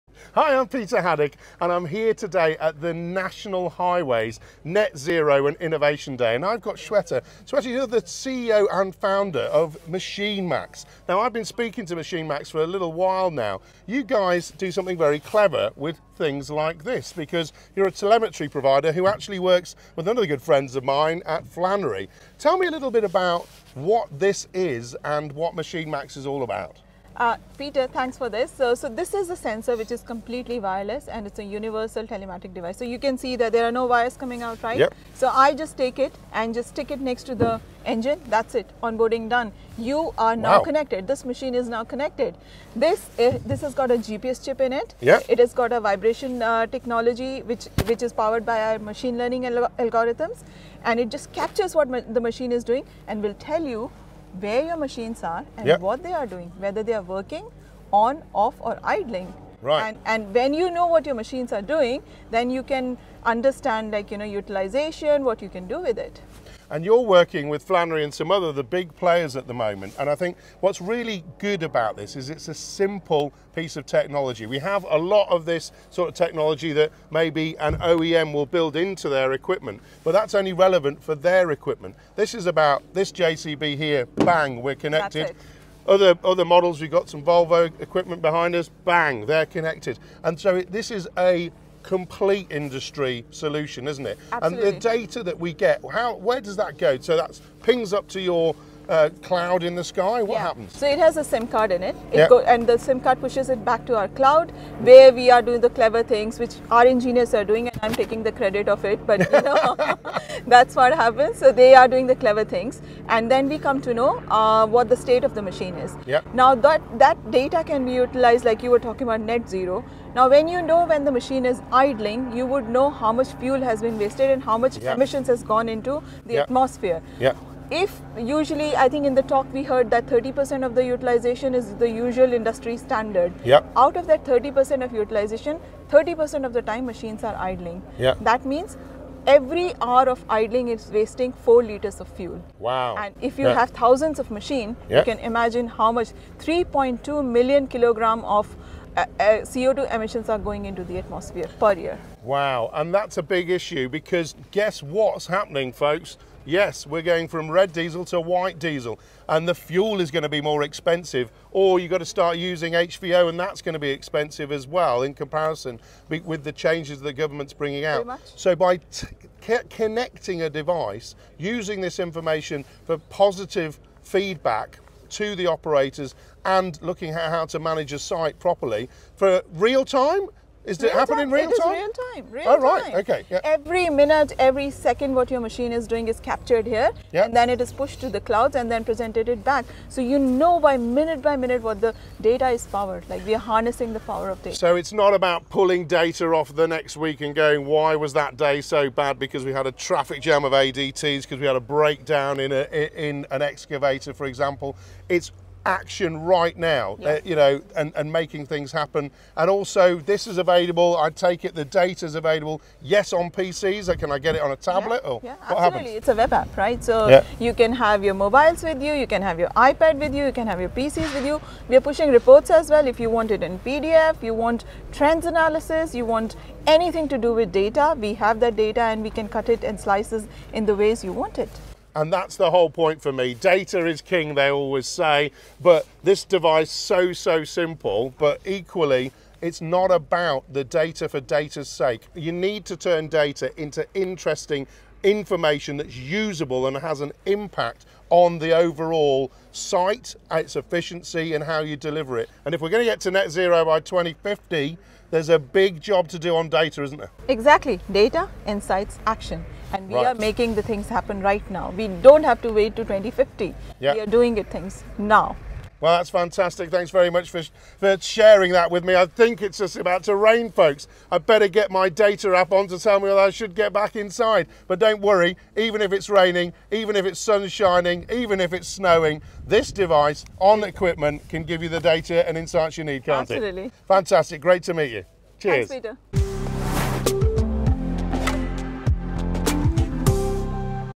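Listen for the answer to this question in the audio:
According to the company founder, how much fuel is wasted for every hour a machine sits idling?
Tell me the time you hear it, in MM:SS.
02:21.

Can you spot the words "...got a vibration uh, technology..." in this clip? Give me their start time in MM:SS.
00:45.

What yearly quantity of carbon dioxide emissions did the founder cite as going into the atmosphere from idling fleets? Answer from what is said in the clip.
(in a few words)
3.2 million kilograms.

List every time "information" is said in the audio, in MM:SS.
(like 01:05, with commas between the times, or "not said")
02:51, 04:05.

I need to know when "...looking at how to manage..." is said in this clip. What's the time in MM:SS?
02:56.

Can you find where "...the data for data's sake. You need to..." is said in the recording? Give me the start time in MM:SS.
04:00.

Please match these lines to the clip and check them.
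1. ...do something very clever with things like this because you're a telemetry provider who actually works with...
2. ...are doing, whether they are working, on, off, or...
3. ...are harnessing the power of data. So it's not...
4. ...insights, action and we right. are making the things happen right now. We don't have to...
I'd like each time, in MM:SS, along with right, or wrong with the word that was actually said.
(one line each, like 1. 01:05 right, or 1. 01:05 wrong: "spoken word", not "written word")
1. 00:14 right
2. 00:56 right
3. 03:13 right
4. 04:18 right.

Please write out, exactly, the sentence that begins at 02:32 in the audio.
Wow, and that's a big issue because guess what's happening, folks?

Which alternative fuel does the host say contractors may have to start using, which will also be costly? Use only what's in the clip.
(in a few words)
HVO.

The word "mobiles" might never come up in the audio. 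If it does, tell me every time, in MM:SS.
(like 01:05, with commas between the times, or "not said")
03:38.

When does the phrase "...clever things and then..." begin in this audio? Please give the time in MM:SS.
01:52.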